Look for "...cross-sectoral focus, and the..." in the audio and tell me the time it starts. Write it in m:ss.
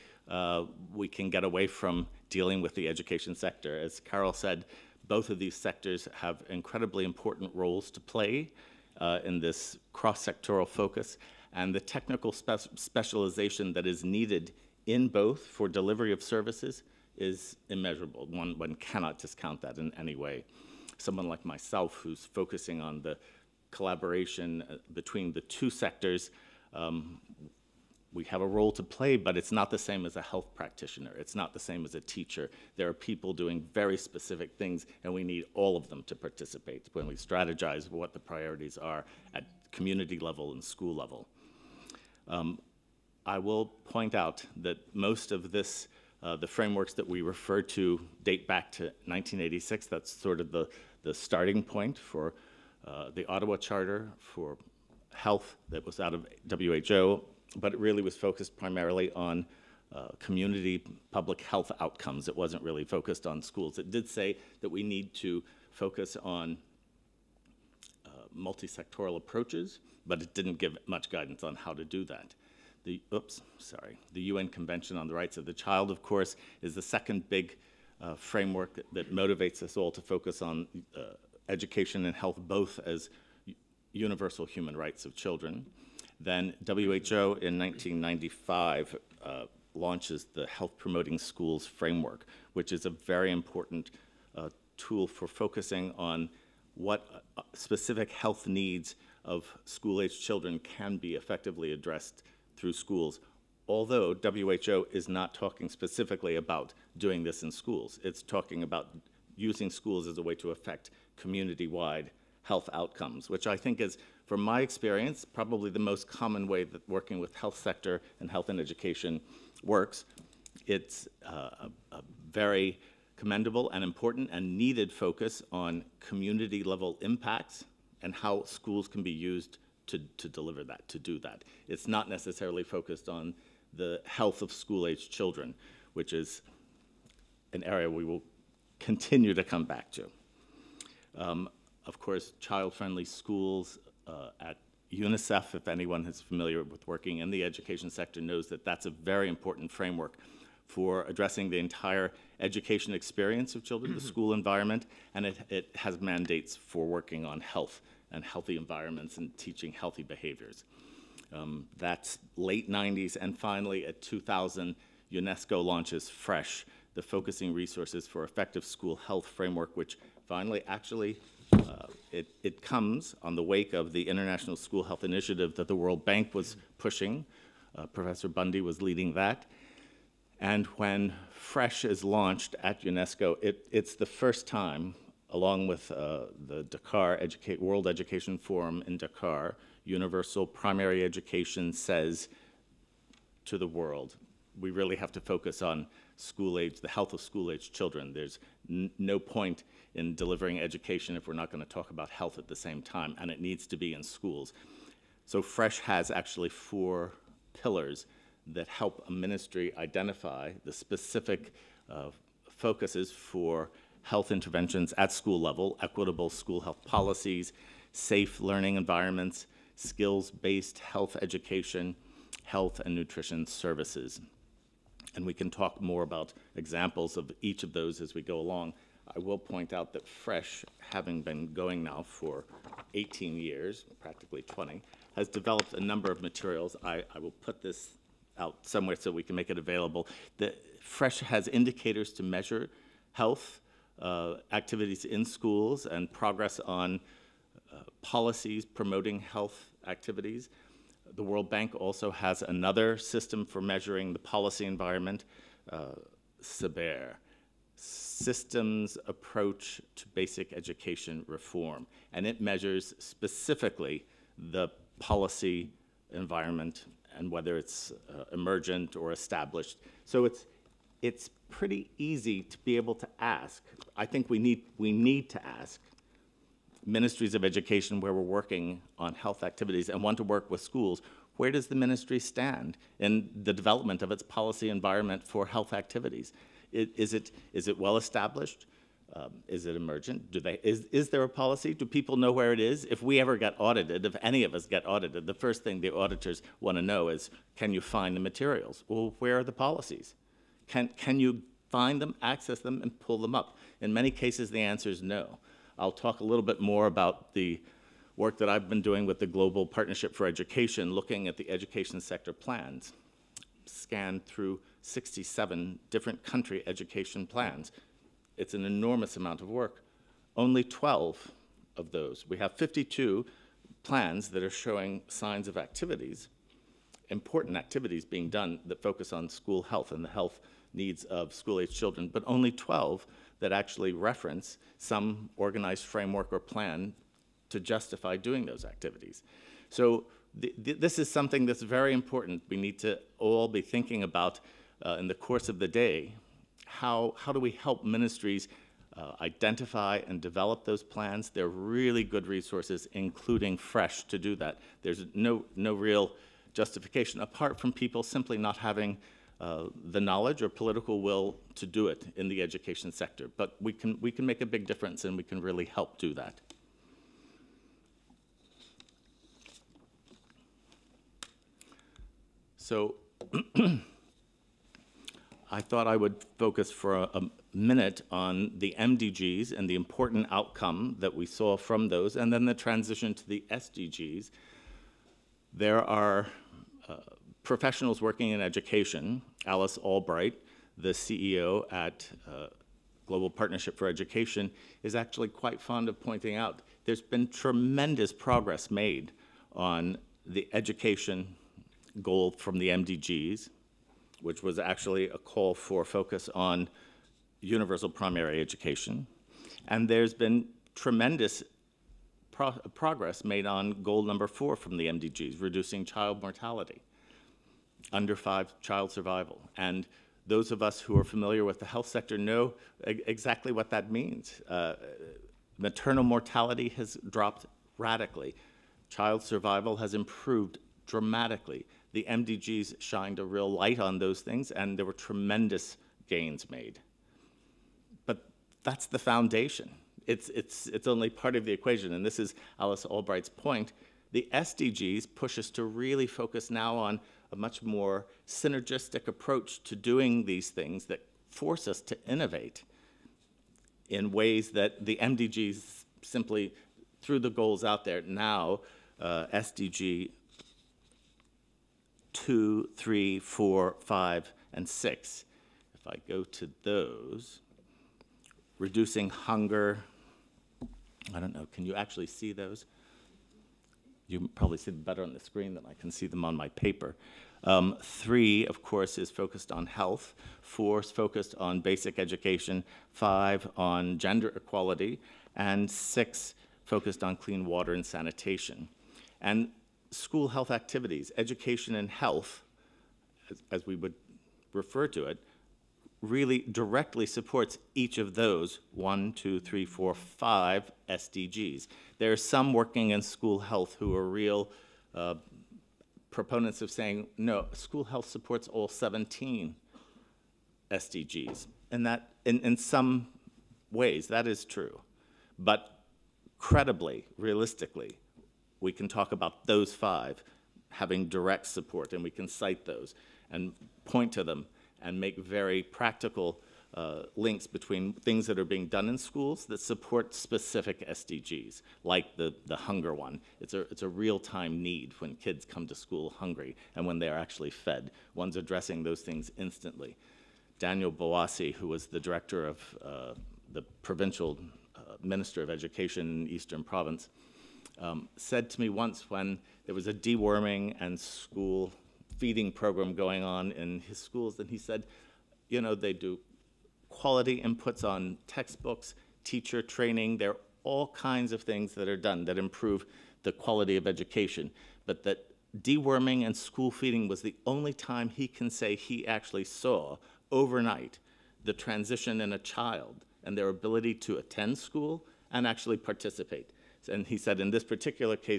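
0:09.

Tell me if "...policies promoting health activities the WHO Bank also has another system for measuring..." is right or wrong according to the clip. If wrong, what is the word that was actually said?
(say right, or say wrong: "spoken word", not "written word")
wrong: "World", not "WHO".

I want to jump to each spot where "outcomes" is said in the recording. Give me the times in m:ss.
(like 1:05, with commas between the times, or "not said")
1:01, 1:52, 6:20.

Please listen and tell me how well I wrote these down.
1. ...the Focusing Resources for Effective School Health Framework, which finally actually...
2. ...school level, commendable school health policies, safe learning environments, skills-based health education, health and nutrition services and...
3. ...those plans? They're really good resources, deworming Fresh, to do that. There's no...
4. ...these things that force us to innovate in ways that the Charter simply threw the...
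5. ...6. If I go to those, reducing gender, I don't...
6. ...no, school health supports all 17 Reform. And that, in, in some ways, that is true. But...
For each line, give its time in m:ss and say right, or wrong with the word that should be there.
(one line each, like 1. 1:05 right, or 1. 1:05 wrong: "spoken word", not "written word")
1. 2:46 right
2. 3:35 wrong: "equitable", not "commendable"
3. 5:50 wrong: "including", not "deworming"
4. 7:30 wrong: "MDGs", not "Charter"
5. 7:44 wrong: "hunger", not "gender"
6. 8:27 wrong: "SDGs", not "Reform".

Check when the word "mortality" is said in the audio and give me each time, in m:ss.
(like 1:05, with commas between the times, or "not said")
6:56, 7:06.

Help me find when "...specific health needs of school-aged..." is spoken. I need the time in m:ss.
1:37.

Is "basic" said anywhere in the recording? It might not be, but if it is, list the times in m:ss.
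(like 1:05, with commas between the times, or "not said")
4:20, 8:01.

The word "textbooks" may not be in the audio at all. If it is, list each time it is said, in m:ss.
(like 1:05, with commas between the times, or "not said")
9:18.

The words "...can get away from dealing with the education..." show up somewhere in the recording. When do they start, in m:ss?
0:01.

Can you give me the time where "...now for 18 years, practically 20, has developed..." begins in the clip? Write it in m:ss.
3:51.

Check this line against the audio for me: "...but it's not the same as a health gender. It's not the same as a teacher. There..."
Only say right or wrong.
wrong.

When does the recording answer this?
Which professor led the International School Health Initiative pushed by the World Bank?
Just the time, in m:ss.
2:57.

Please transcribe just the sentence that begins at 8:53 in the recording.
It's a, it's a real time need when kids come to school hungry and when they are actually fed.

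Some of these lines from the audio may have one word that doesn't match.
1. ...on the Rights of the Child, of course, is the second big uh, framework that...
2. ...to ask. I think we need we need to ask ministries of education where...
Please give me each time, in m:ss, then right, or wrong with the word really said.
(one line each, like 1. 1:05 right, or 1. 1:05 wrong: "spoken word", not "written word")
1. 1:14 right
2. 4:32 right.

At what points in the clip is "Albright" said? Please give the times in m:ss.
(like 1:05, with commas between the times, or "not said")
6:29, 7:22.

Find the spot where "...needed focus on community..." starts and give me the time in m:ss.
2:04.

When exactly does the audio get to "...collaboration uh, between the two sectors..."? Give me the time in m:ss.
0:23.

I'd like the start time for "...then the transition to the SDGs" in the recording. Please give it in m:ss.
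6:22.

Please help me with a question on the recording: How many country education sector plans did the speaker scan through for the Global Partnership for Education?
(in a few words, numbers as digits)
67.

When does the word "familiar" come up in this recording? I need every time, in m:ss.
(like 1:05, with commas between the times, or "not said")
2:26, 7:01.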